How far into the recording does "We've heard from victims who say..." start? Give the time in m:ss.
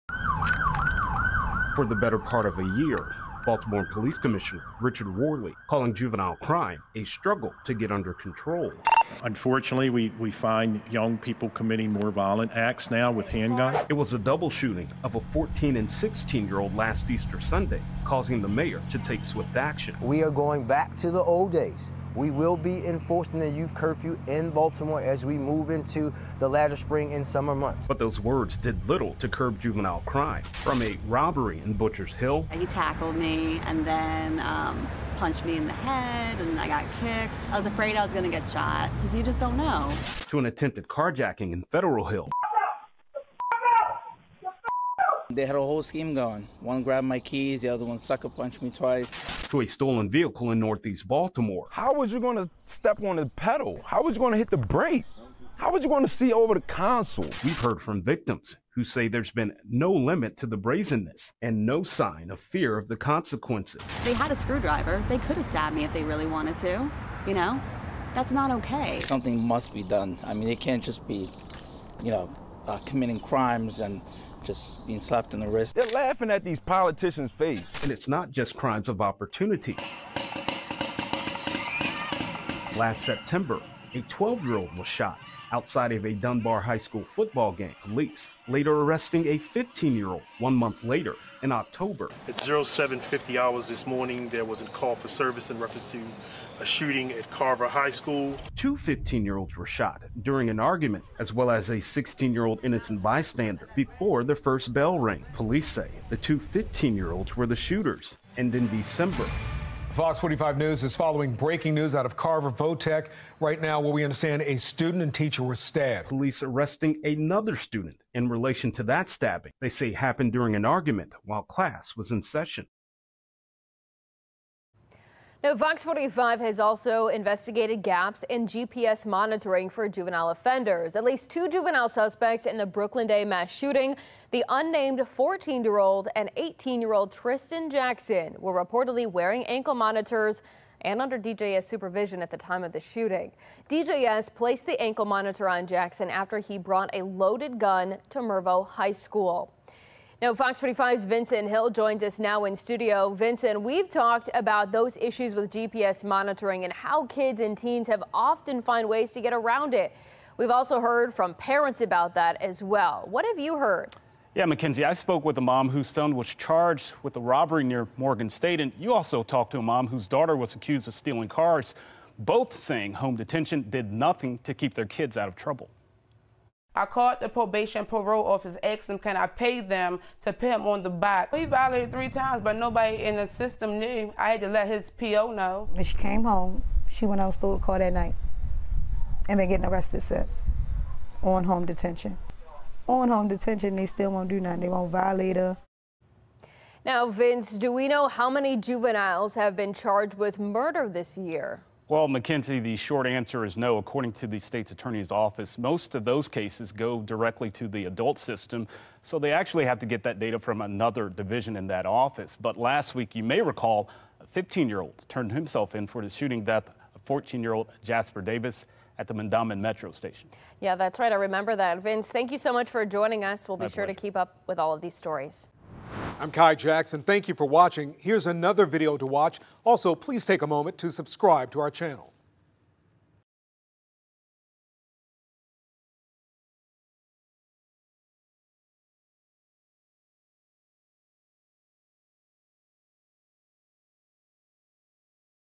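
0:57.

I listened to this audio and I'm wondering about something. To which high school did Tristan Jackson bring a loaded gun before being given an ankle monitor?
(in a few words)
Mervo High School.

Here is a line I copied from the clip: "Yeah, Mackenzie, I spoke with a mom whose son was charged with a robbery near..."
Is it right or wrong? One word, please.
right.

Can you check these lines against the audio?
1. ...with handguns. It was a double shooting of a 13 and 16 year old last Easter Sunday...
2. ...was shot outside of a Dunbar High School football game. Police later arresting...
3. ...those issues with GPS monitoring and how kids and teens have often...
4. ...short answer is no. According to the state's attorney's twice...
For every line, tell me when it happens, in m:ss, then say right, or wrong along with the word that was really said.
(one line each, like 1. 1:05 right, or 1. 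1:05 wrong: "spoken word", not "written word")
1. 0:13 wrong: "14", not "13"
2. 1:24 right
3. 2:34 right
4. 3:22 wrong: "office", not "twice".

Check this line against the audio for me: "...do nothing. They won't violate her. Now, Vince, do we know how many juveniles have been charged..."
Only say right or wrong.
right.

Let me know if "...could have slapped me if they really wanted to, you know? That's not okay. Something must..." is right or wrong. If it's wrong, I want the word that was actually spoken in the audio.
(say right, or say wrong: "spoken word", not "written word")
wrong: "stabbed", not "slapped".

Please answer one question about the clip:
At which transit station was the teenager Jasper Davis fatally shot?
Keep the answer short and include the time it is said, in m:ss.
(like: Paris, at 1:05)
Mondawmin Metro Station, at 3:39.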